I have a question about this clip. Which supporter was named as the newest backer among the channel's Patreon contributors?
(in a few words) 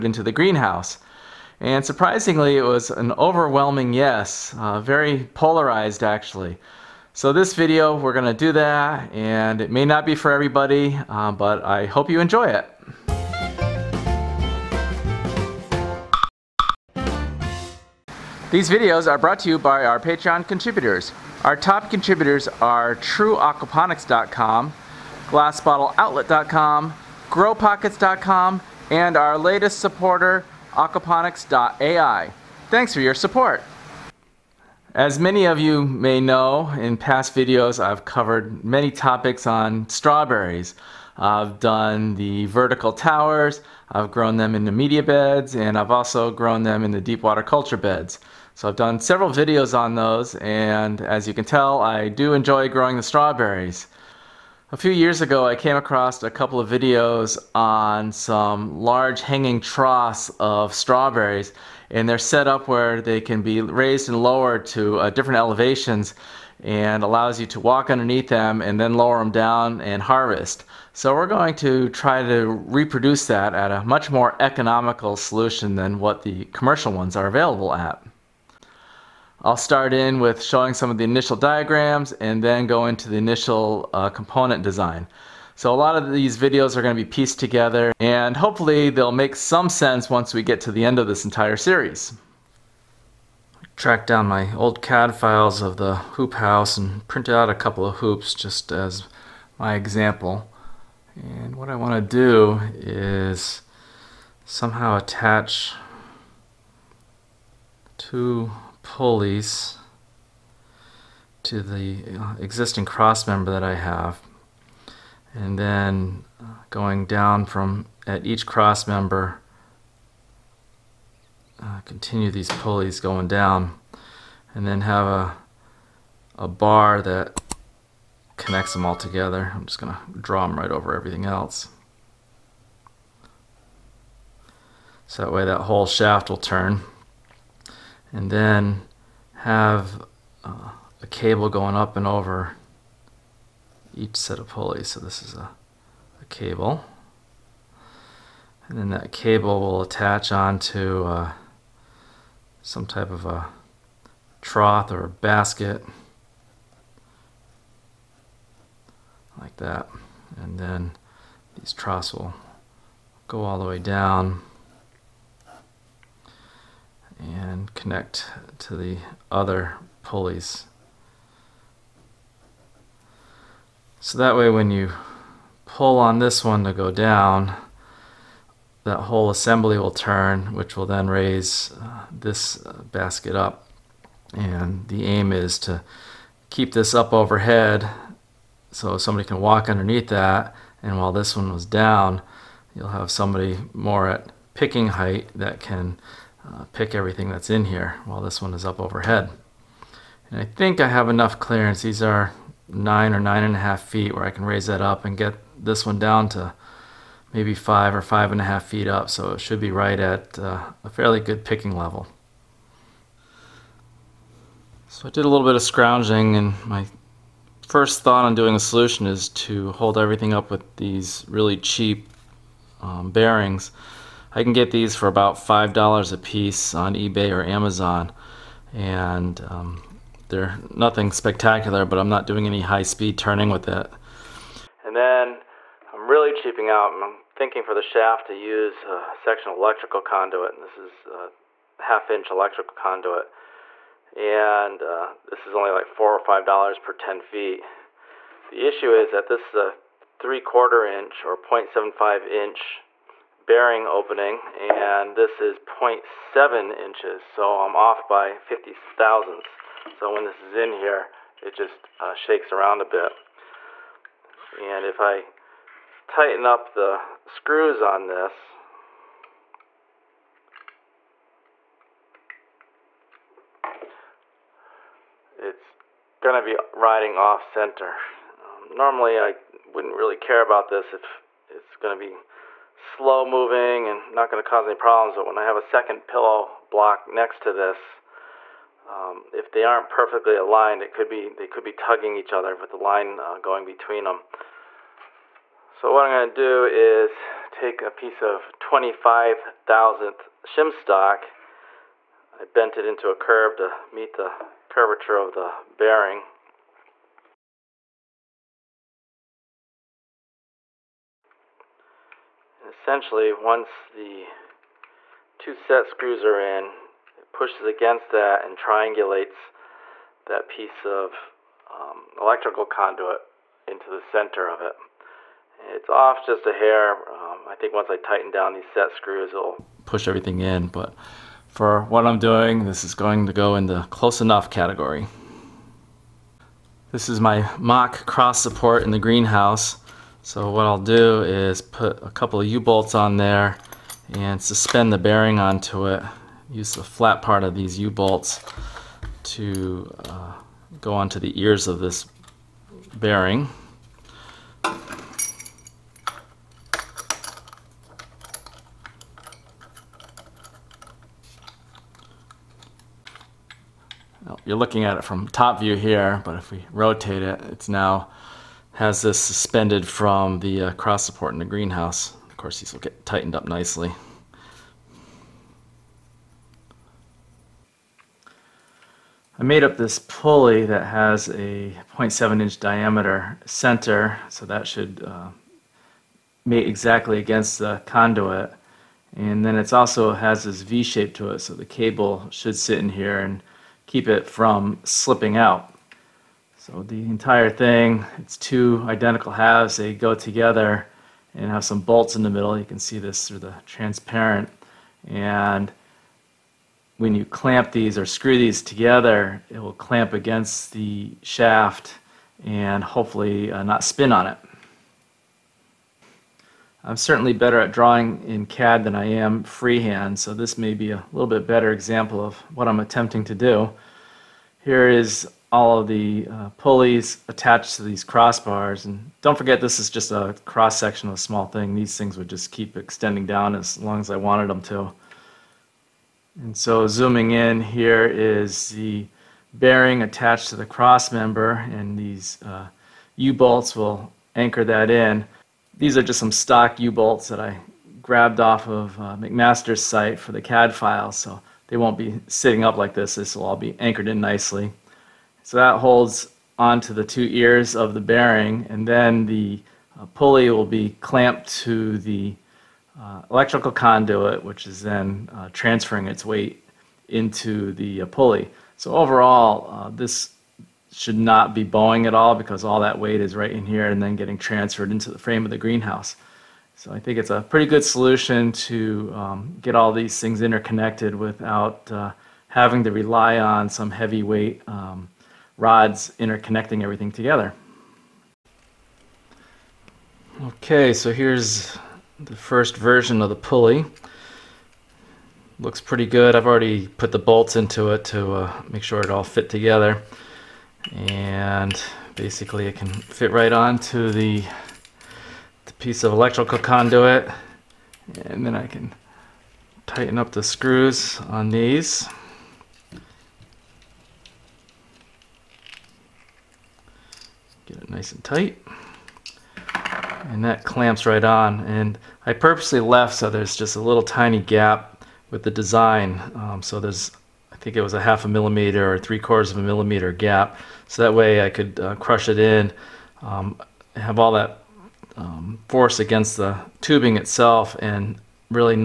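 Aquaponics.ai.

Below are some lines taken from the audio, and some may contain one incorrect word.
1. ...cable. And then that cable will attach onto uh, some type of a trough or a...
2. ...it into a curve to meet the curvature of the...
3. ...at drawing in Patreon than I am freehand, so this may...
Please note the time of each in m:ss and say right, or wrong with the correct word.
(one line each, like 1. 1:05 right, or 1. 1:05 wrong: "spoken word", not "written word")
1. 2:26 right
2. 5:02 right
3. 6:57 wrong: "CAD", not "Patreon".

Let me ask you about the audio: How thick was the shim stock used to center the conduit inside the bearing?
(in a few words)
25 thousandths.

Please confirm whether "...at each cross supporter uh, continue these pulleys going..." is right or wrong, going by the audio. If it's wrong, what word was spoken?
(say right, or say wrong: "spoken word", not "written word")
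wrong: "member", not "supporter".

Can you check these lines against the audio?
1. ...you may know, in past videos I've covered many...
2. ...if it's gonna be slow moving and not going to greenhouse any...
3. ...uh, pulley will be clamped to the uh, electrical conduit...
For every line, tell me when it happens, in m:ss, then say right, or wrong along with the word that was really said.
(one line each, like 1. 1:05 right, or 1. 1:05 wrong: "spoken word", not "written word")
1. 0:35 right
2. 4:40 wrong: "cause", not "greenhouse"
3. 7:39 right.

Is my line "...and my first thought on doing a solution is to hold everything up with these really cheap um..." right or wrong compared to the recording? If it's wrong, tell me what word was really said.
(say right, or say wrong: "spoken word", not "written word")
right.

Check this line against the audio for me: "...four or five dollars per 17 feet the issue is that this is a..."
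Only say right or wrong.
wrong.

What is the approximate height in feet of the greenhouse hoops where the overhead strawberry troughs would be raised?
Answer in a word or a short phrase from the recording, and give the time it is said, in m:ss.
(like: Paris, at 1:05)
9 or 9.5 feet, at 3:22.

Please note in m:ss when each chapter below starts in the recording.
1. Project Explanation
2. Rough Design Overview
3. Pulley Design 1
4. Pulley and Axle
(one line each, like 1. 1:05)
1. 0:34
2. 1:32
3. 6:17
4. 3:33.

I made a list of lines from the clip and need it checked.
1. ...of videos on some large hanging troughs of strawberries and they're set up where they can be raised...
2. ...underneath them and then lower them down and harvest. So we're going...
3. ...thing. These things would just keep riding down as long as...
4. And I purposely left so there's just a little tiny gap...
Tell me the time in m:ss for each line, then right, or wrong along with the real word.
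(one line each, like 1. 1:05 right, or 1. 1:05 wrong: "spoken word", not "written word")
1. 0:56 right
2. 1:07 right
3. 7:11 wrong: "extending", not "riding"
4. 8:41 right.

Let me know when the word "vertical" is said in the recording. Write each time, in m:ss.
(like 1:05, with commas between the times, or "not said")
0:42.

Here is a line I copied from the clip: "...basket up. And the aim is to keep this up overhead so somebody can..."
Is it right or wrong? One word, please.
right.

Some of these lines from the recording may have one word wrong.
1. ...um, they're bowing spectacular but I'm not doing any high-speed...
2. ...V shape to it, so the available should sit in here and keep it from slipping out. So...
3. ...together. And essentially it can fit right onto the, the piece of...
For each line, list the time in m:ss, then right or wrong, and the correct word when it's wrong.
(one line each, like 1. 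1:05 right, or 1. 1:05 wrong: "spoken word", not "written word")
1. 3:49 wrong: "nothing", not "bowing"
2. 6:30 wrong: "cable", not "available"
3. 8:19 wrong: "basically", not "essentially".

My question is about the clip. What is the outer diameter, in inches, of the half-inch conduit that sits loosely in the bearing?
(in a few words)
0.7 inches.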